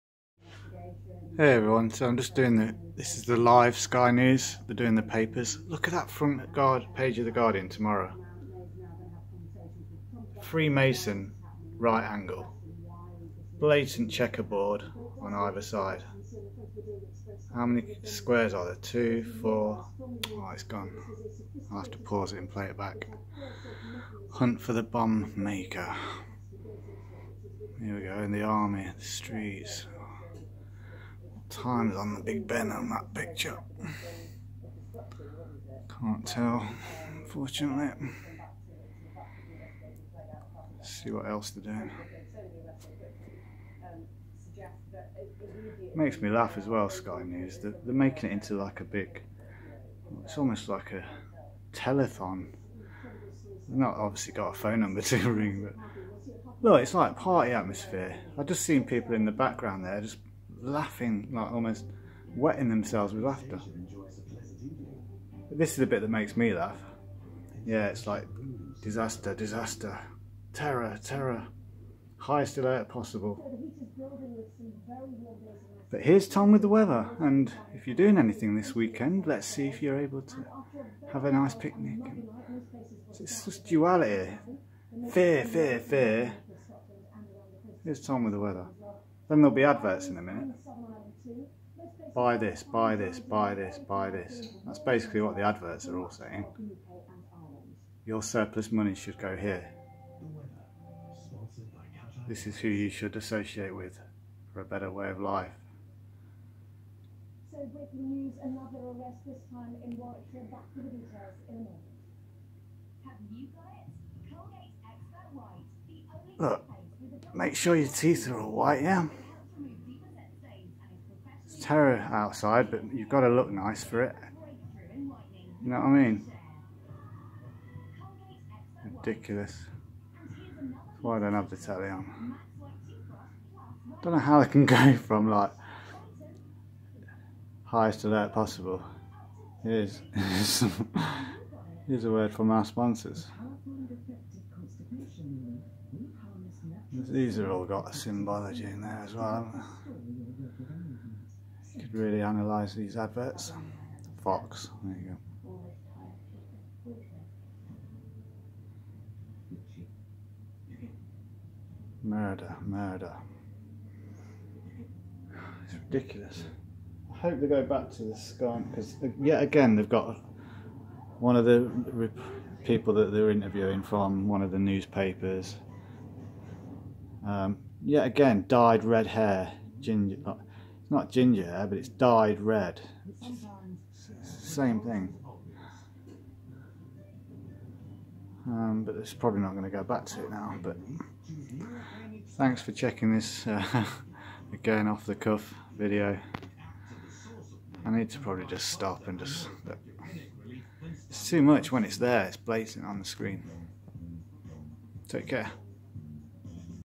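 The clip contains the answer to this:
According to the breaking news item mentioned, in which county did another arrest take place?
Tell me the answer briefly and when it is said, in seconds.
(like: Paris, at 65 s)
Warwickshire, at 109 s.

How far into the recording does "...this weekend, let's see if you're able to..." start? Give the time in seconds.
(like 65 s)
78 s.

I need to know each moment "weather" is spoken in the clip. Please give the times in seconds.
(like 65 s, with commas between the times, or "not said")
76 s, 88 s.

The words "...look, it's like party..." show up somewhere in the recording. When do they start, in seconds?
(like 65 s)
56 s.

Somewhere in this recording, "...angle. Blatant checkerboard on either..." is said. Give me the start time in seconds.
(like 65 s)
12 s.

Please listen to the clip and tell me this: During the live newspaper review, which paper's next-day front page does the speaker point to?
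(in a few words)
The Guardian.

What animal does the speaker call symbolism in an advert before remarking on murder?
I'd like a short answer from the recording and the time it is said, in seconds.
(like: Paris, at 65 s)
Fox, at 154 s.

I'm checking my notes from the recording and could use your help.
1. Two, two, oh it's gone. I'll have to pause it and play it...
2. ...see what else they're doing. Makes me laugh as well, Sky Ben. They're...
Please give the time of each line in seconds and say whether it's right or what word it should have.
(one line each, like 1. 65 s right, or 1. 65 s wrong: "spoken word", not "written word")
1. 18 s wrong: "four", not "two"
2. 40 s wrong: "News", not "Ben".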